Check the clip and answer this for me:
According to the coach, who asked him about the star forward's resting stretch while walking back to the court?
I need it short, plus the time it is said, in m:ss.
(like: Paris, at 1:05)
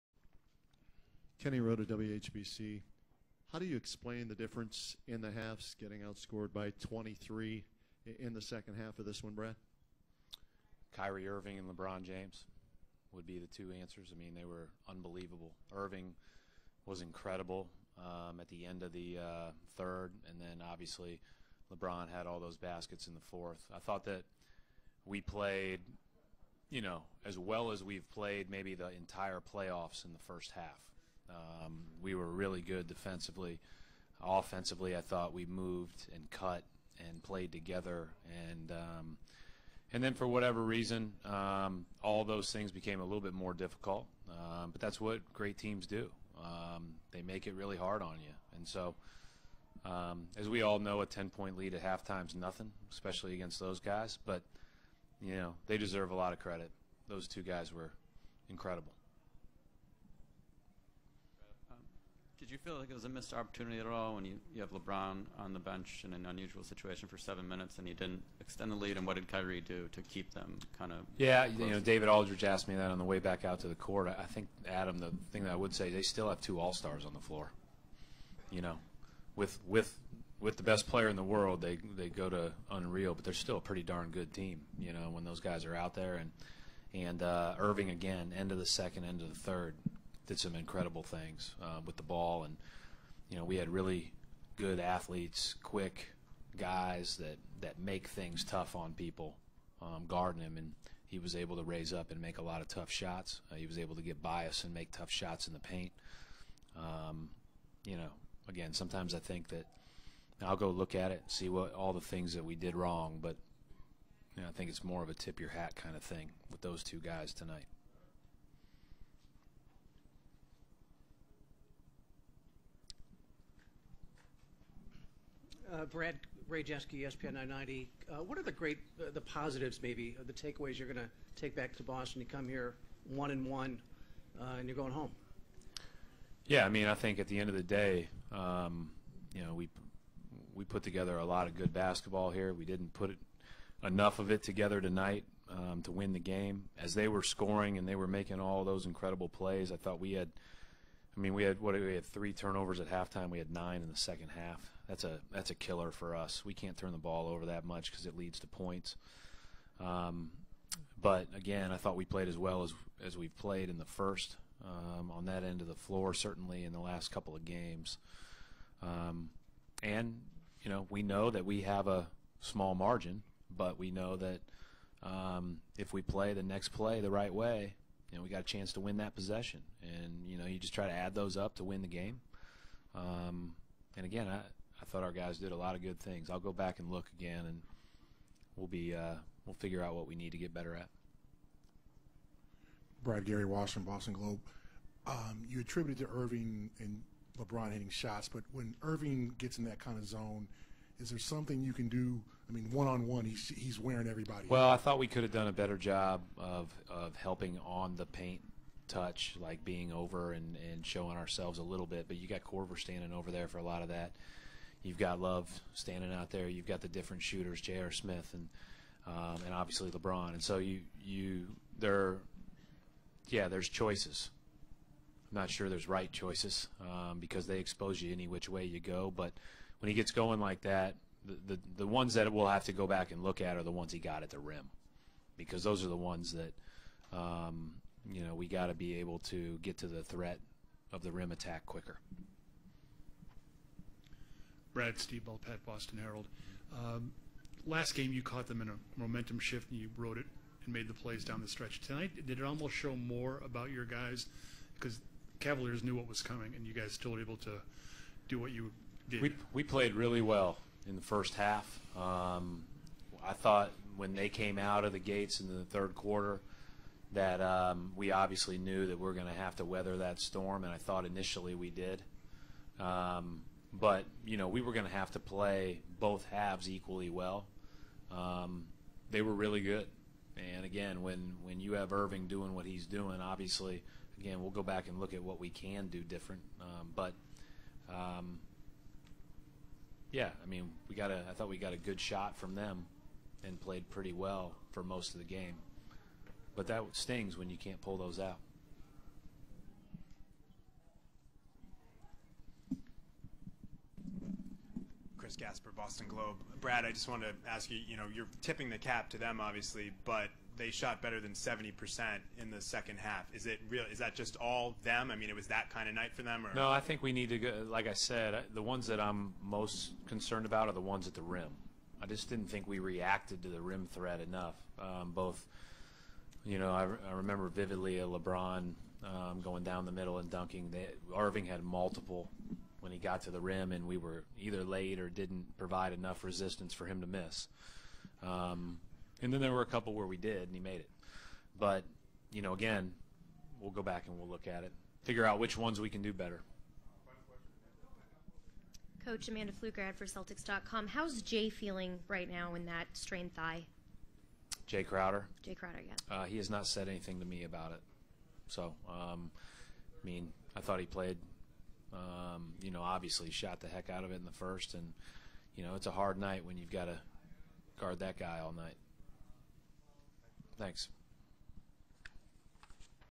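David Aldridge, at 1:11.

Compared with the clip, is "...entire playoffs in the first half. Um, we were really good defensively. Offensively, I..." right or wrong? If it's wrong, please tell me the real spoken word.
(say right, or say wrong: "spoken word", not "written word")
right.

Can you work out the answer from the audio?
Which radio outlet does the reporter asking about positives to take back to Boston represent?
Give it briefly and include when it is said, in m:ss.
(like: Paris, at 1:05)
ESPN 990, at 2:07.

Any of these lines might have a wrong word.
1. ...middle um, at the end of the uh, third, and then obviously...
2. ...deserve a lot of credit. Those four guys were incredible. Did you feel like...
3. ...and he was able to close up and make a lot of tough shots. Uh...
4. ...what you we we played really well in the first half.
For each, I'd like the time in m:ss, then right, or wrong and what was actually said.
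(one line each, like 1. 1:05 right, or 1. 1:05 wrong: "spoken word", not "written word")
1. 0:17 wrong: "incredible", not "middle"
2. 0:55 wrong: "two", not "four"
3. 1:40 wrong: "raise", not "close"
4. 4:18 right.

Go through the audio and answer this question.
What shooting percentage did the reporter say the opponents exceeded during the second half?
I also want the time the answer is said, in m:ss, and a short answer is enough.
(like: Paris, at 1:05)
70%, at 5:11.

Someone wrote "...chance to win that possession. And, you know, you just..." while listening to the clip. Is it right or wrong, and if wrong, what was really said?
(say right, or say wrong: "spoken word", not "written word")
right.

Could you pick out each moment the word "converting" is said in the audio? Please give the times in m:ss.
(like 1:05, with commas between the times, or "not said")
not said.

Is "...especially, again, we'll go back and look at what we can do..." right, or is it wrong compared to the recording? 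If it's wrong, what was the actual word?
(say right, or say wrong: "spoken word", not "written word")
wrong: "obviously", not "especially".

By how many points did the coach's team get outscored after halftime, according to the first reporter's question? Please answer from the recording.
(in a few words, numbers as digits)
23.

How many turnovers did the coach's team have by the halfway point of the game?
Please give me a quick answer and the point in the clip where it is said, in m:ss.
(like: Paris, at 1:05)
3, at 2:32.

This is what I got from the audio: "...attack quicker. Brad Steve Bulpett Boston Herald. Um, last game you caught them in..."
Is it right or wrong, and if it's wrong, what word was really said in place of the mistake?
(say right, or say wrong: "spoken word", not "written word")
right.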